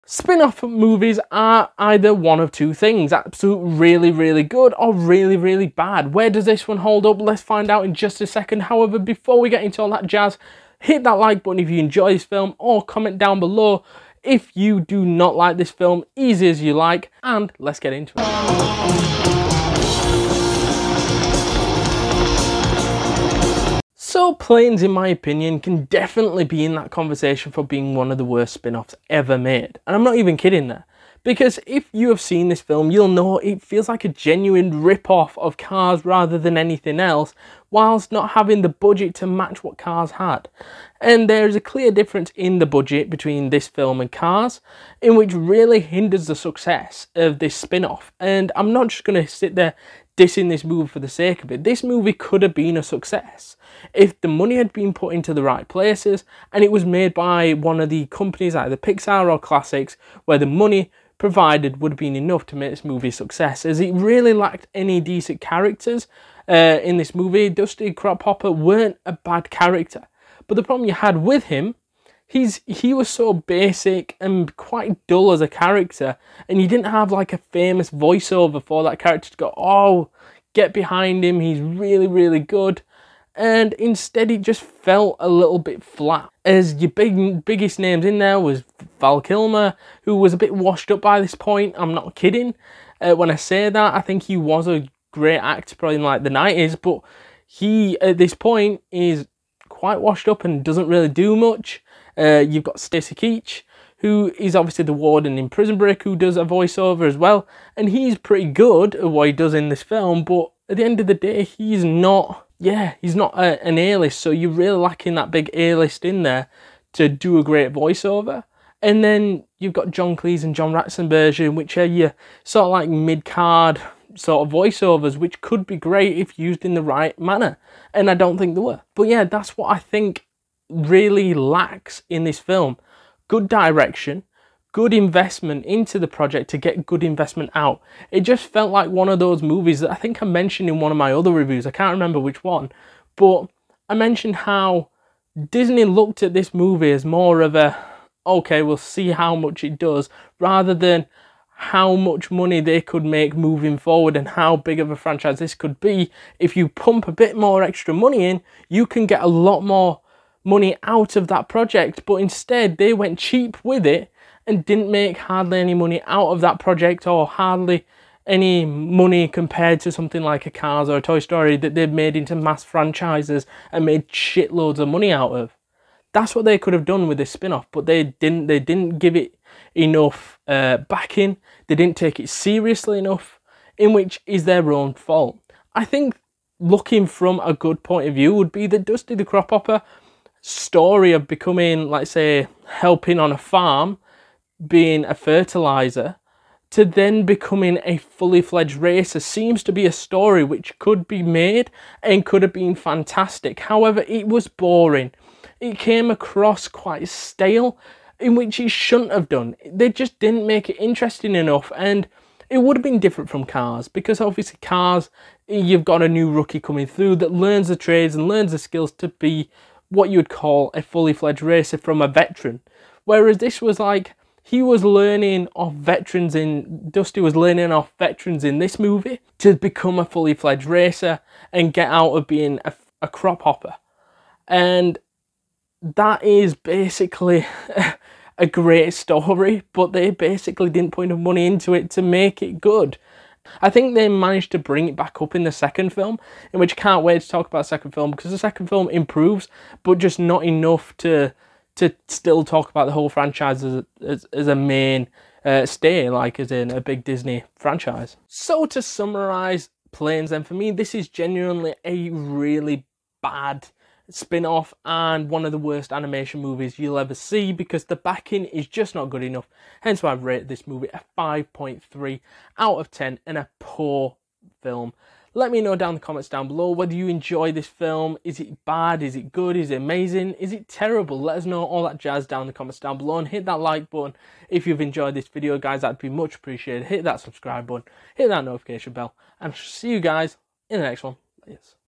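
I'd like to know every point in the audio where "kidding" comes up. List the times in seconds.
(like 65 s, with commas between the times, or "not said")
30 s, 92 s.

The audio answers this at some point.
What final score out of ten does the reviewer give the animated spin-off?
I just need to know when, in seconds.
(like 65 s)
271 s.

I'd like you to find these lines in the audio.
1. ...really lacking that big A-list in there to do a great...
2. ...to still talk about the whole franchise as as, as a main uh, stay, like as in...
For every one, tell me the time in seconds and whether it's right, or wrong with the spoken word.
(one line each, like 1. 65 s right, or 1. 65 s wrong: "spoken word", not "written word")
1. 114 s right
2. 251 s right.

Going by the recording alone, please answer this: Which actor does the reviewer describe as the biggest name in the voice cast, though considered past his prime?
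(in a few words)
Val Kilmer.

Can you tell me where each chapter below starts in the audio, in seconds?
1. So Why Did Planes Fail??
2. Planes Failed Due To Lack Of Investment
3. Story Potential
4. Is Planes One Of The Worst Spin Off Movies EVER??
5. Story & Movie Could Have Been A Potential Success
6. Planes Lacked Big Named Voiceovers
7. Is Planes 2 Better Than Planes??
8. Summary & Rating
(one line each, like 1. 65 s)
1. 143 s
2. 43 s
3. 189 s
4. 28 s
5. 65 s
6. 90 s
7. 247 s
8. 258 s.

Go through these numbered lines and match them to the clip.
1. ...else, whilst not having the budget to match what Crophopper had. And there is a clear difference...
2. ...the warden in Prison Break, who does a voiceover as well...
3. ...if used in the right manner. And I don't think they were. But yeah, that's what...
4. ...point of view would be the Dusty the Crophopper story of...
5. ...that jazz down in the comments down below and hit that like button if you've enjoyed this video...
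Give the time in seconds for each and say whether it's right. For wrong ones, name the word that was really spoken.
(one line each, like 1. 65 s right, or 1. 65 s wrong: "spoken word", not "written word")
1. 36 s wrong: "Cars", not "Crophopper"
2. 104 s right
3. 126 s right
4. 187 s right
5. 281 s right.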